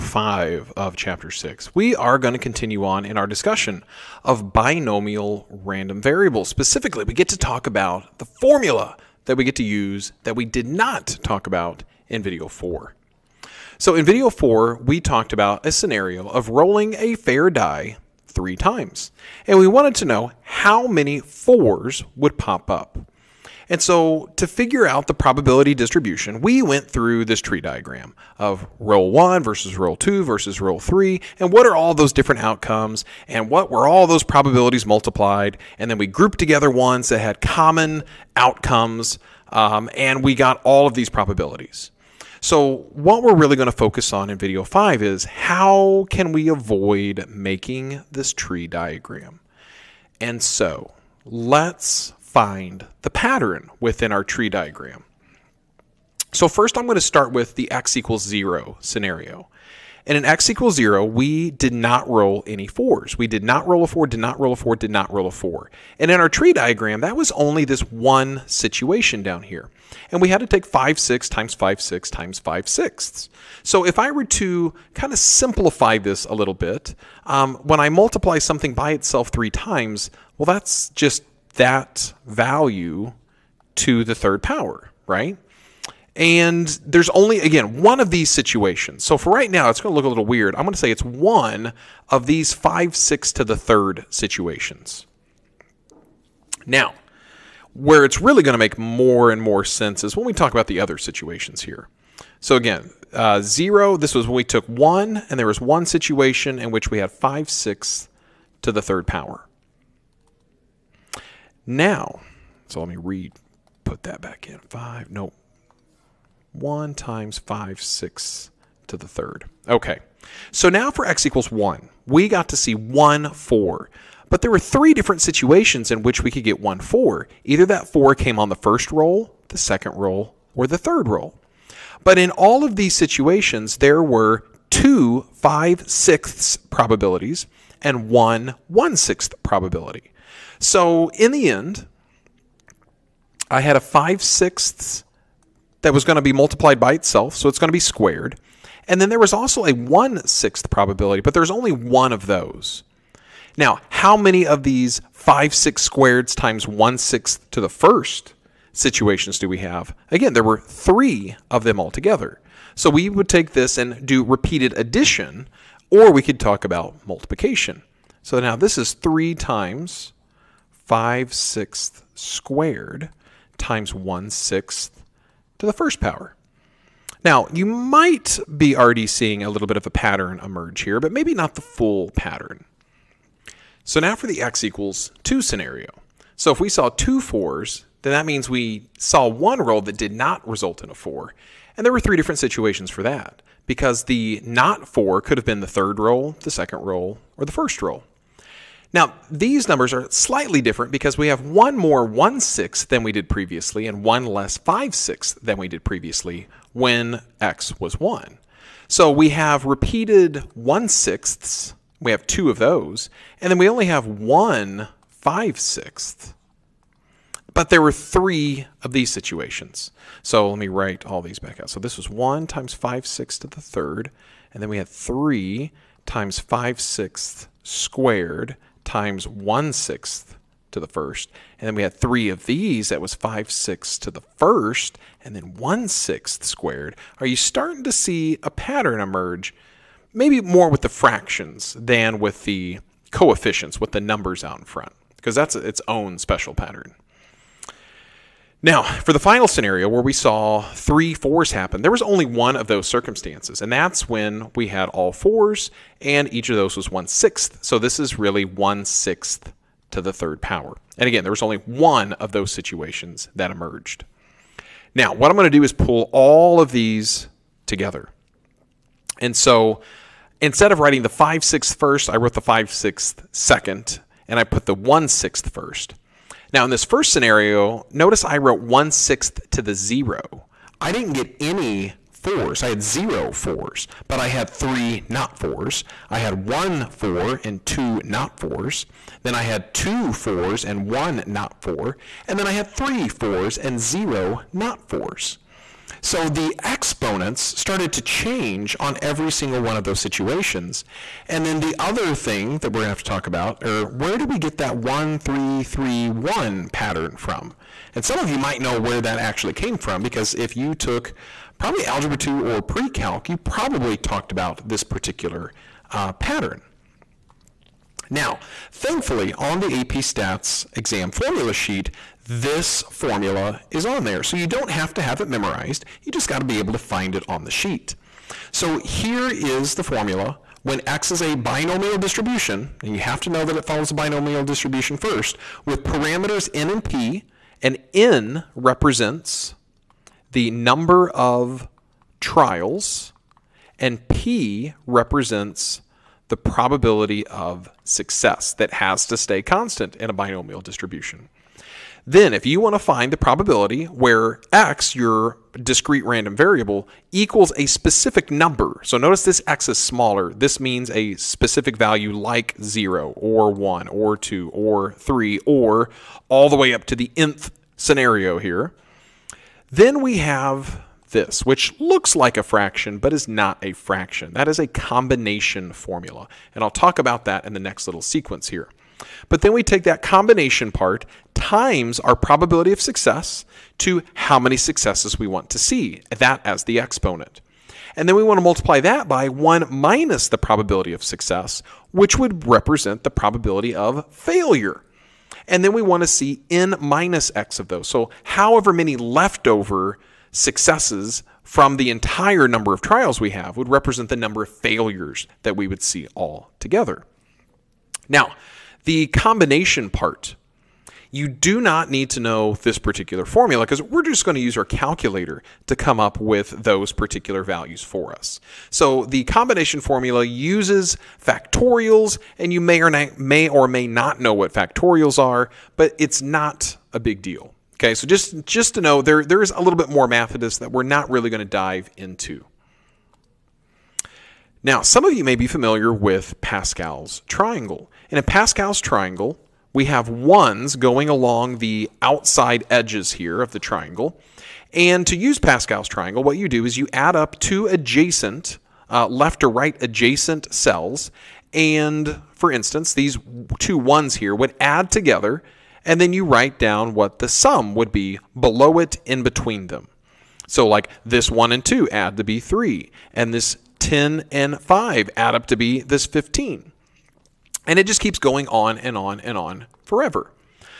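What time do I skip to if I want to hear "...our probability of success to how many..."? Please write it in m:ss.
6:21.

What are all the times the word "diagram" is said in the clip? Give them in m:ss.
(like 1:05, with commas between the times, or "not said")
0:27, 0:48, 0:54, 1:06.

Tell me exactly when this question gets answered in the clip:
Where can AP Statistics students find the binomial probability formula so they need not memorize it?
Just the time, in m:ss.
5:21.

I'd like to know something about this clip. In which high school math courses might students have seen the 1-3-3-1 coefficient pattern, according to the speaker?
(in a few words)
Algebra 2 or pre-calc.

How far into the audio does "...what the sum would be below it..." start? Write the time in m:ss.
7:36.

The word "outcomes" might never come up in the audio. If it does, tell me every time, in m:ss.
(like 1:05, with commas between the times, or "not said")
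0:32, 0:38.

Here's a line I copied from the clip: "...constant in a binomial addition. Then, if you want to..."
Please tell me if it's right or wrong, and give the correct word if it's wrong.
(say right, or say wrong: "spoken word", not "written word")
wrong: "distribution", not "addition".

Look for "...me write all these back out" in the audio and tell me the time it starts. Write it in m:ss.
3:40.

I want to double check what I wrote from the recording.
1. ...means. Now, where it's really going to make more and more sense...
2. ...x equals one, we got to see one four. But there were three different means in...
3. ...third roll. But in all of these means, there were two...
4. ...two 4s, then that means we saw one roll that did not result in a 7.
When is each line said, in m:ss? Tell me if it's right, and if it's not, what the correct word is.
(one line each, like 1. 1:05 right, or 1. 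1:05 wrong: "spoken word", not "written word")
1. 1:34 wrong: "situations", not "means"
2. 2:01 wrong: "situations", not "means"
3. 2:10 wrong: "situations", not "means"
4. 3:06 wrong: "4", not "7".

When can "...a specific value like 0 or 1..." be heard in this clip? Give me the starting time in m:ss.
6:00.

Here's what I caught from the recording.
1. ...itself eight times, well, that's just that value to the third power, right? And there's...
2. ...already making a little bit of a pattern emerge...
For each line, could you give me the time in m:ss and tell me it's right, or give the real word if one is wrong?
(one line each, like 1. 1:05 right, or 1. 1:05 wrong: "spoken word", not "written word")
1. 1:18 wrong: "three", not "eight"
2. 2:58 wrong: "seeing", not "making".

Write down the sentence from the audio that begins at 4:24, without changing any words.
Now, what I'm going to do is pull all of these together.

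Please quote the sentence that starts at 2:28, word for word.
And then there was also a 1 sixth probability, but there's only one of those.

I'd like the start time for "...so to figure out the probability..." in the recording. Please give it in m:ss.
0:23.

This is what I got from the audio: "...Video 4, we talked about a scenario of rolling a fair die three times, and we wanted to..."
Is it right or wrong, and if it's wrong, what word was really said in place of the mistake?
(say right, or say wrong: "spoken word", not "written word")
right.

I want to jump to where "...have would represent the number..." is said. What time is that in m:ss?
6:43.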